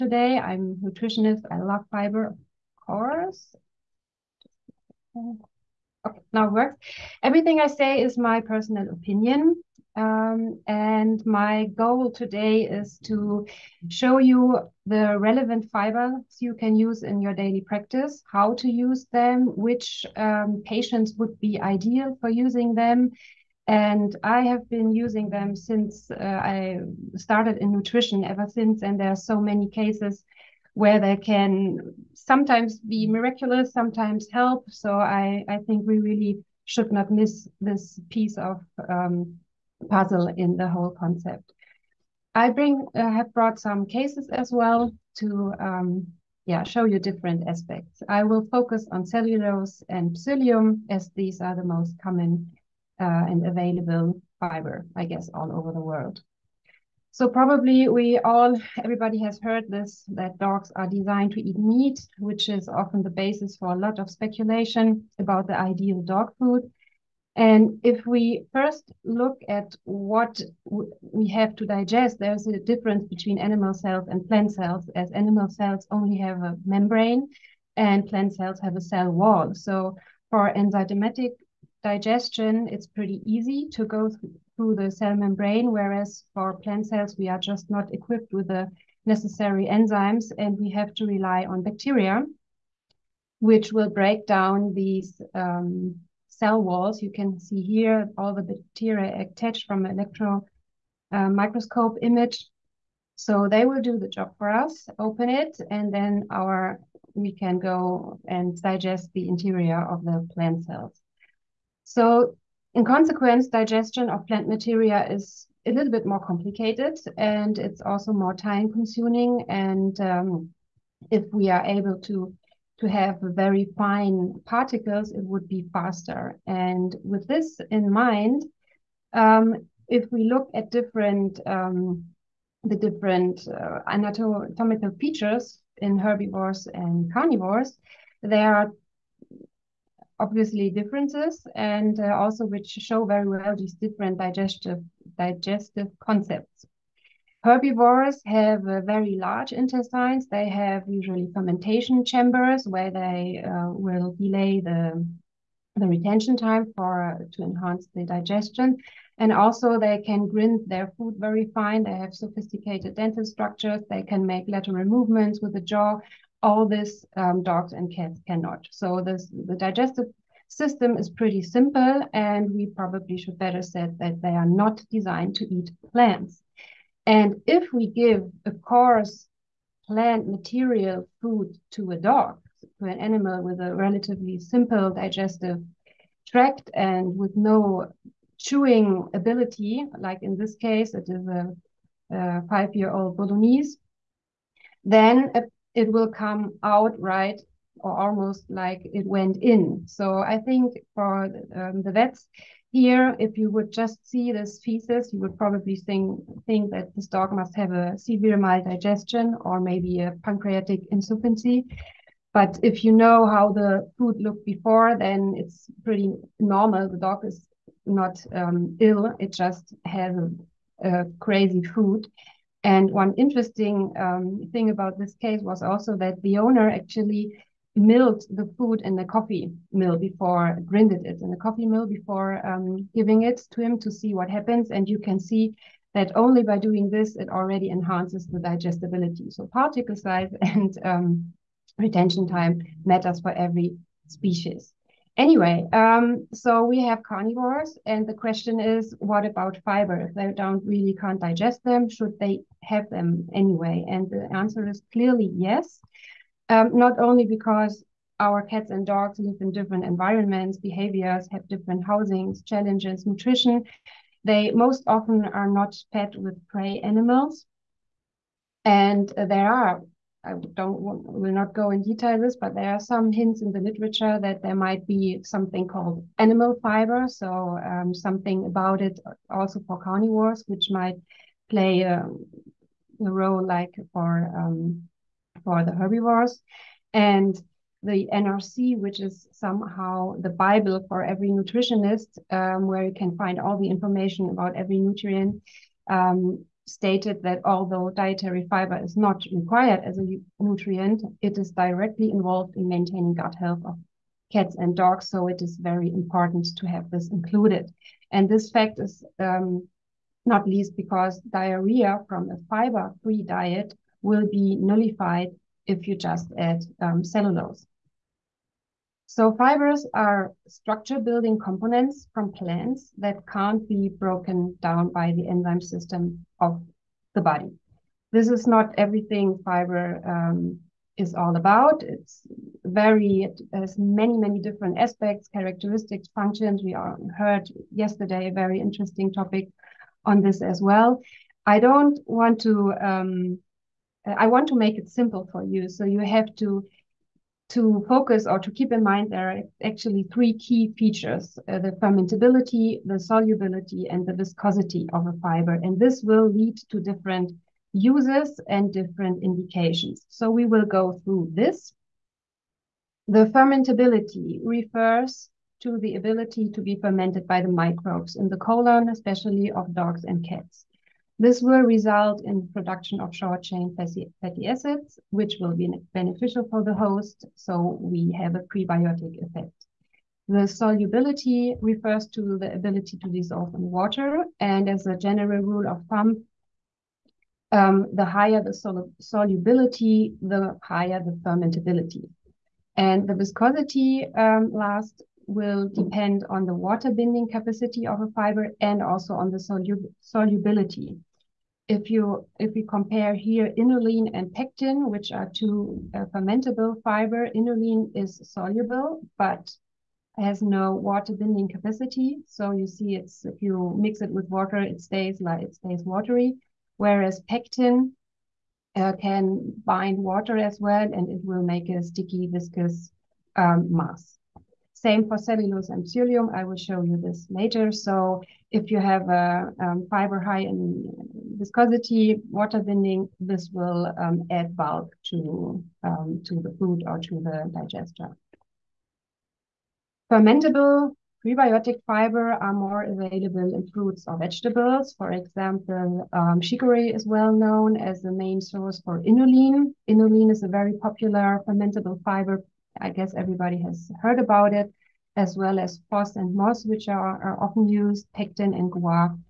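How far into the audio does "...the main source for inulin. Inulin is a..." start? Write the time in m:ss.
7:28.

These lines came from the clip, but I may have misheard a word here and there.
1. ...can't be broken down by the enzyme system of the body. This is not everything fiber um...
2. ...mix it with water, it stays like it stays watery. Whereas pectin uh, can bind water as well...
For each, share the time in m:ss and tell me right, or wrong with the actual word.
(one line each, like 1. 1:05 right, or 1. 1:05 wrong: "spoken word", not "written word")
1. 5:23 right
2. 6:53 right.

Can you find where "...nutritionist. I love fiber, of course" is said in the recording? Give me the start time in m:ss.
0:00.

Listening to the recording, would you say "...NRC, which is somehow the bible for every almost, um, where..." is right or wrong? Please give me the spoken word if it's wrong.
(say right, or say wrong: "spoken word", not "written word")
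wrong: "nutritionist", not "almost".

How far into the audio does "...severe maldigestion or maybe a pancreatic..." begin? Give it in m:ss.
3:27.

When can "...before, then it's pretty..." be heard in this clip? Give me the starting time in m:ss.
3:34.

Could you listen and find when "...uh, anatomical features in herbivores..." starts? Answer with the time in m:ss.
2:13.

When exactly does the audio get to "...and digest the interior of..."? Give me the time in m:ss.
1:48.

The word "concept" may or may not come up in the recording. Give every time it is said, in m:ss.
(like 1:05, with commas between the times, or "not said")
0:40, 2:25.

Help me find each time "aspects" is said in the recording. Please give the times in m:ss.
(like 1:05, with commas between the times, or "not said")
0:47, 5:34.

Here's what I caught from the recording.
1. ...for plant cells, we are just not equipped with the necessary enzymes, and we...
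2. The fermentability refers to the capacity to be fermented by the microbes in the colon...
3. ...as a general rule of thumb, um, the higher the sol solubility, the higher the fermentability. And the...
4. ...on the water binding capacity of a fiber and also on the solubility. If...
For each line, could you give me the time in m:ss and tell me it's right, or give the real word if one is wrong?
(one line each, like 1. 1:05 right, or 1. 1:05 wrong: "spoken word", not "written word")
1. 1:26 right
2. 6:03 wrong: "ability", not "capacity"
3. 6:24 right
4. 6:36 right.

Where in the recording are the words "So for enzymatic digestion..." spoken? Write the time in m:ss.
1:19.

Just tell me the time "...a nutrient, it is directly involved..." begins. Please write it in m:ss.
4:59.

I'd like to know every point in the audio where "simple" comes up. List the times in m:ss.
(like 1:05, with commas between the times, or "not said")
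2:51, 3:04, 5:44.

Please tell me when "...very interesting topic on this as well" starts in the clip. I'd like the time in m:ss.
5:38.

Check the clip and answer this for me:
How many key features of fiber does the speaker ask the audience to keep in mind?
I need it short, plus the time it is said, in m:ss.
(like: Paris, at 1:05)
3, at 5:50.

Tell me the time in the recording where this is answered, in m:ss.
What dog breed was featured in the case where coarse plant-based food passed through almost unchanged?
3:13.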